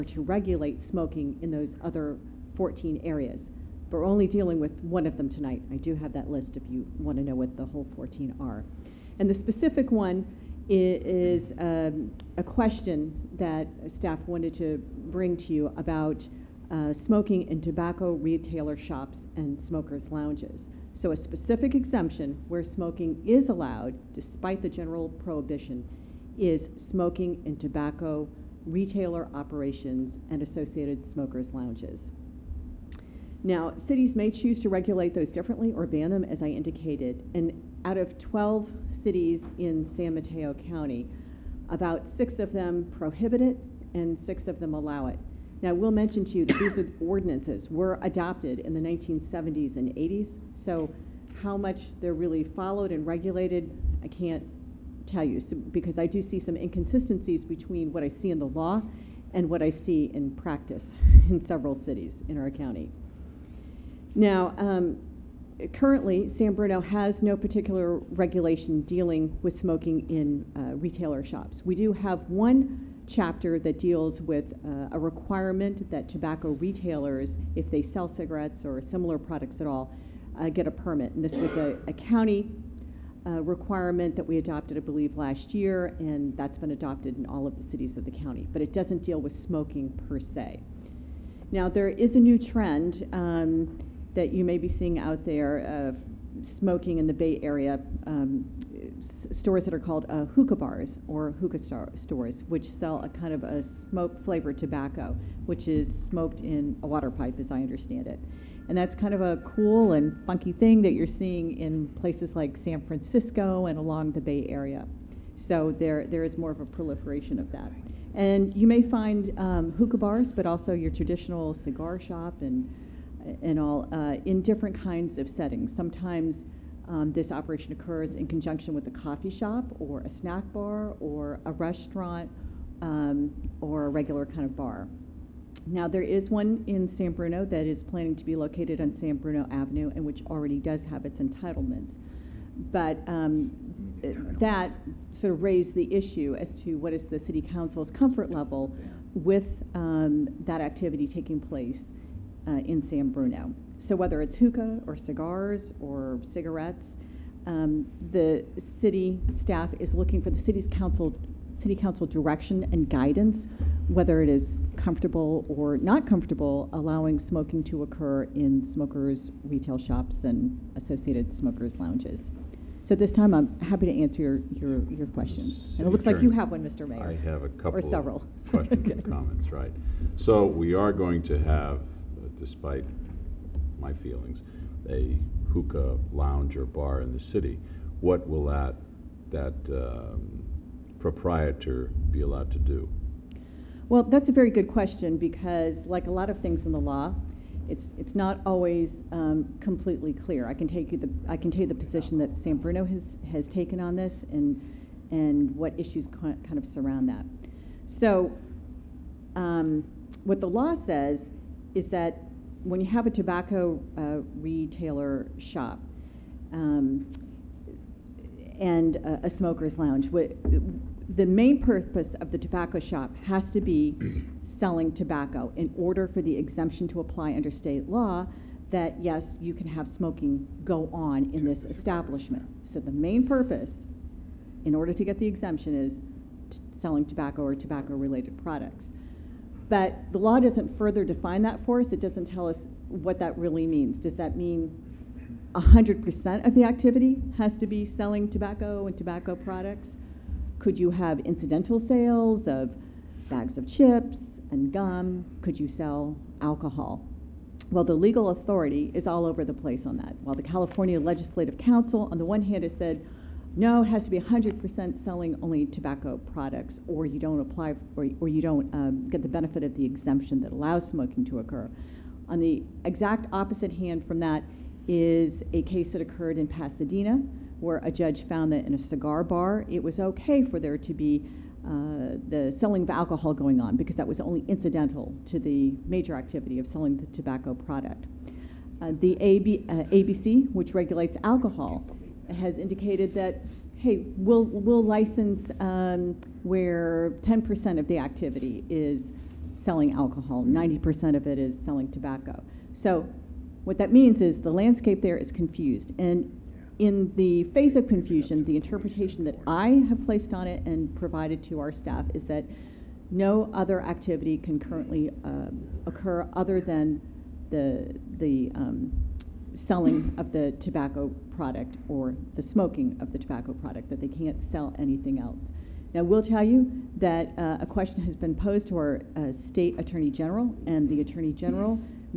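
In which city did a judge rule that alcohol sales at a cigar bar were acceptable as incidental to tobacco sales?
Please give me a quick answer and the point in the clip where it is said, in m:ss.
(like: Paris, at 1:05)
Pasadena, at 4:36.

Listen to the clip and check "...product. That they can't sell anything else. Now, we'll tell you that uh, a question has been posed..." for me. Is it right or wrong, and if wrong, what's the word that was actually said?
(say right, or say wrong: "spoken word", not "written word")
right.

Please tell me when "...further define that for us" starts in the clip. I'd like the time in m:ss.
4:00.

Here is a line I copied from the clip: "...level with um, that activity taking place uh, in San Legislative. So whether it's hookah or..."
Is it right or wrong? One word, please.
wrong.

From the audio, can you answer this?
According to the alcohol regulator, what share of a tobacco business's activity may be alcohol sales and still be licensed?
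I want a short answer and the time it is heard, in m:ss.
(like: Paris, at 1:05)
10%, at 4:57.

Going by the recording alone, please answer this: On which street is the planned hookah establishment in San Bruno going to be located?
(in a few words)
San Bruno Avenue.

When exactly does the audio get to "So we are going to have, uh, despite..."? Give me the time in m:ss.
3:00.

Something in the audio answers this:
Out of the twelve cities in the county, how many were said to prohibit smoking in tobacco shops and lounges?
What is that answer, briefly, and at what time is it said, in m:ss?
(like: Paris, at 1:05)
6, at 0:41.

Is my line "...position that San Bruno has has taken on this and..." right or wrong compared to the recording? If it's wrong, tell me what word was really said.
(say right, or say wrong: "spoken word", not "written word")
right.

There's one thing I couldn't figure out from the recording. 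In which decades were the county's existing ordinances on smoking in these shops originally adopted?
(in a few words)
1970s and 80s.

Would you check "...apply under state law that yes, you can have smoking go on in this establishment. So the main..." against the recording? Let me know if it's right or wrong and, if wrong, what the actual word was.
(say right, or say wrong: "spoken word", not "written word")
right.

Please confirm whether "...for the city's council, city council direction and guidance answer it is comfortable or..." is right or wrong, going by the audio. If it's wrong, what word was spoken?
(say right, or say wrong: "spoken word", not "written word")
wrong: "whether", not "answer".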